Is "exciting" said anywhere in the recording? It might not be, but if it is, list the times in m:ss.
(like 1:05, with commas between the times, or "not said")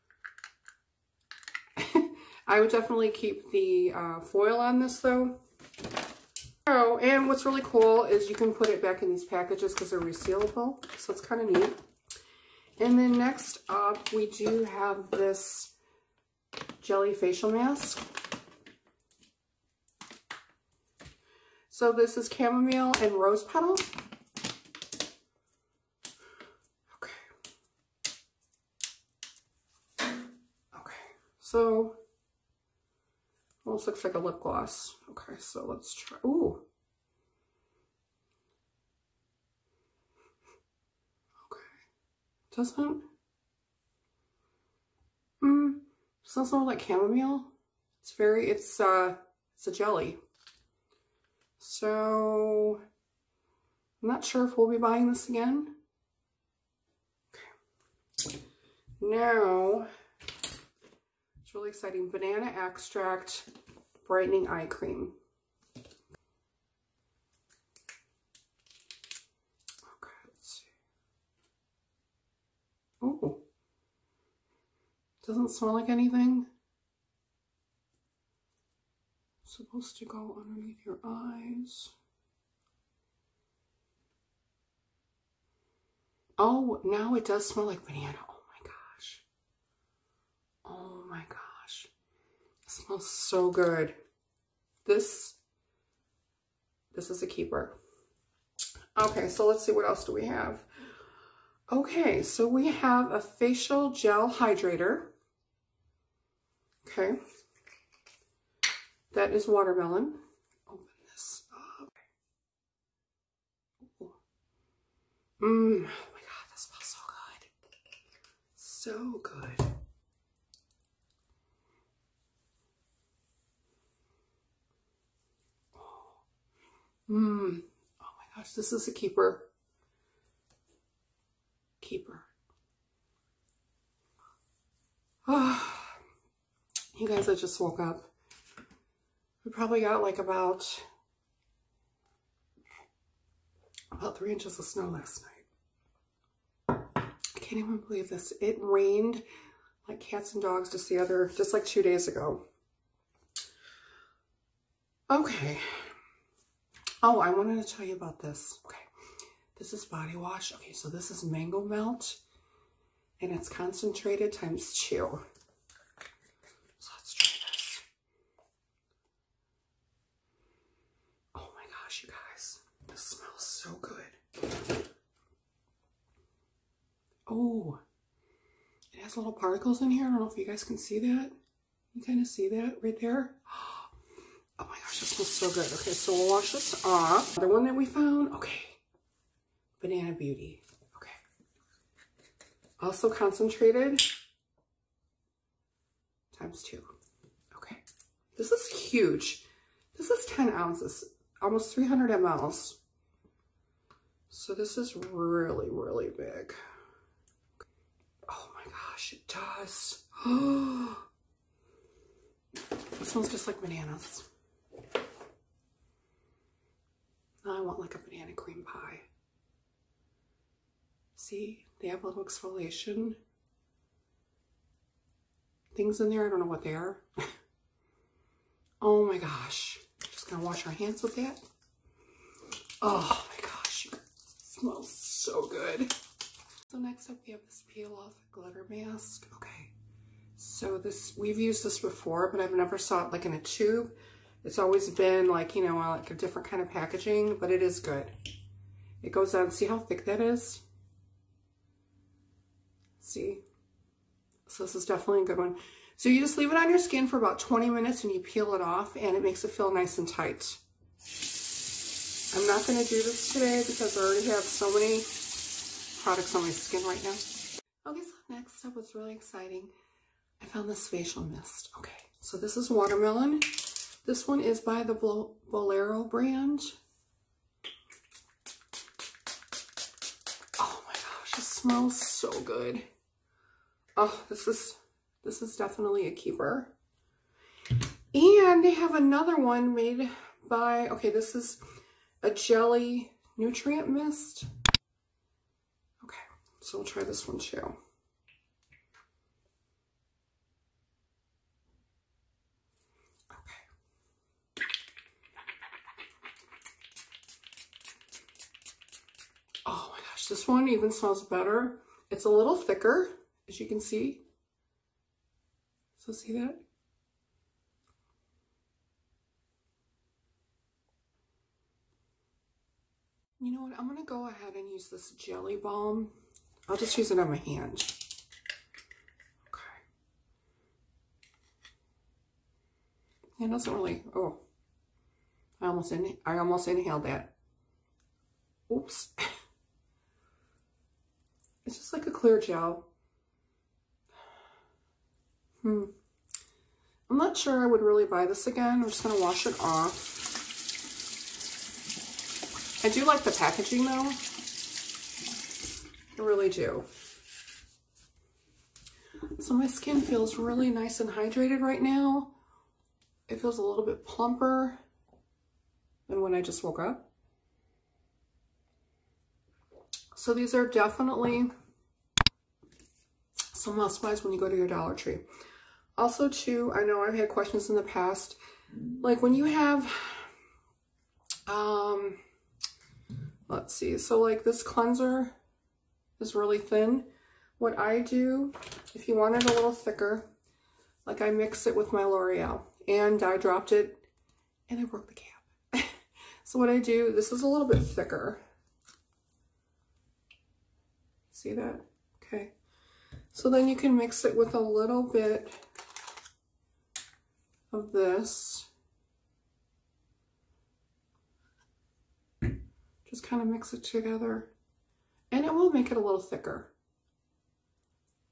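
1:01, 4:29.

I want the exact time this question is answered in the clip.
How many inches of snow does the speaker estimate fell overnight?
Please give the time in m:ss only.
2:24.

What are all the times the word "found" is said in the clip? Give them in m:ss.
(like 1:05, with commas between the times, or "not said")
3:07, 4:30.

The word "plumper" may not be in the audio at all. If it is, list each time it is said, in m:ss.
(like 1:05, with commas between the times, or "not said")
6:04.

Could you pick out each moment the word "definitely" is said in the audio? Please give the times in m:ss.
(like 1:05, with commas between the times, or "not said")
0:02, 4:14, 4:45, 6:10.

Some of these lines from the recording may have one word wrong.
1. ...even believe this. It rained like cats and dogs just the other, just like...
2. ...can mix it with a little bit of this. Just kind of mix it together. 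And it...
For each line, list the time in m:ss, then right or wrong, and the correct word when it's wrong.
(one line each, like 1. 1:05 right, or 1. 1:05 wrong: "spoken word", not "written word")
1. 2:27 right
2. 6:43 right.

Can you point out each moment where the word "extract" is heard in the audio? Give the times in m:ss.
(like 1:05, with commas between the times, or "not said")
1:02.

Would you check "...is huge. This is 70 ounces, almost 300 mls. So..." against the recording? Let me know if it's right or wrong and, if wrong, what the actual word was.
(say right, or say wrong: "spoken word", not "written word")
wrong: "10", not "70".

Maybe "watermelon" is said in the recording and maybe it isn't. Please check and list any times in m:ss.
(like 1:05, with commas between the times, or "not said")
1:49, 4:32.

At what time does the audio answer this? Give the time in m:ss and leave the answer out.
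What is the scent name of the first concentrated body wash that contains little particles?
2:41.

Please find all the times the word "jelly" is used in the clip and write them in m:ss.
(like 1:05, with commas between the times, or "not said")
0:16, 0:49, 4:52, 5:25.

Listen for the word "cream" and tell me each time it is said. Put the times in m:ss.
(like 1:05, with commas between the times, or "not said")
1:04, 3:38.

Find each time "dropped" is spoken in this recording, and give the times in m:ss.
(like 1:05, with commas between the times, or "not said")
6:33.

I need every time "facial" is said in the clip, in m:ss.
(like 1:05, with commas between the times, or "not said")
0:17, 1:43, 4:30.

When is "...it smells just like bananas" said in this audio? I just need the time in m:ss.
3:32.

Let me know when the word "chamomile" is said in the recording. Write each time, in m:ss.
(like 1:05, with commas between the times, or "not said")
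0:22, 0:46.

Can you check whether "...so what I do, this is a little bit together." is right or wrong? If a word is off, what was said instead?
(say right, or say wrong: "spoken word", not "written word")
wrong: "thicker", not "together".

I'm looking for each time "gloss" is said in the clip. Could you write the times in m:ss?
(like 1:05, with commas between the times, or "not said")
0:34.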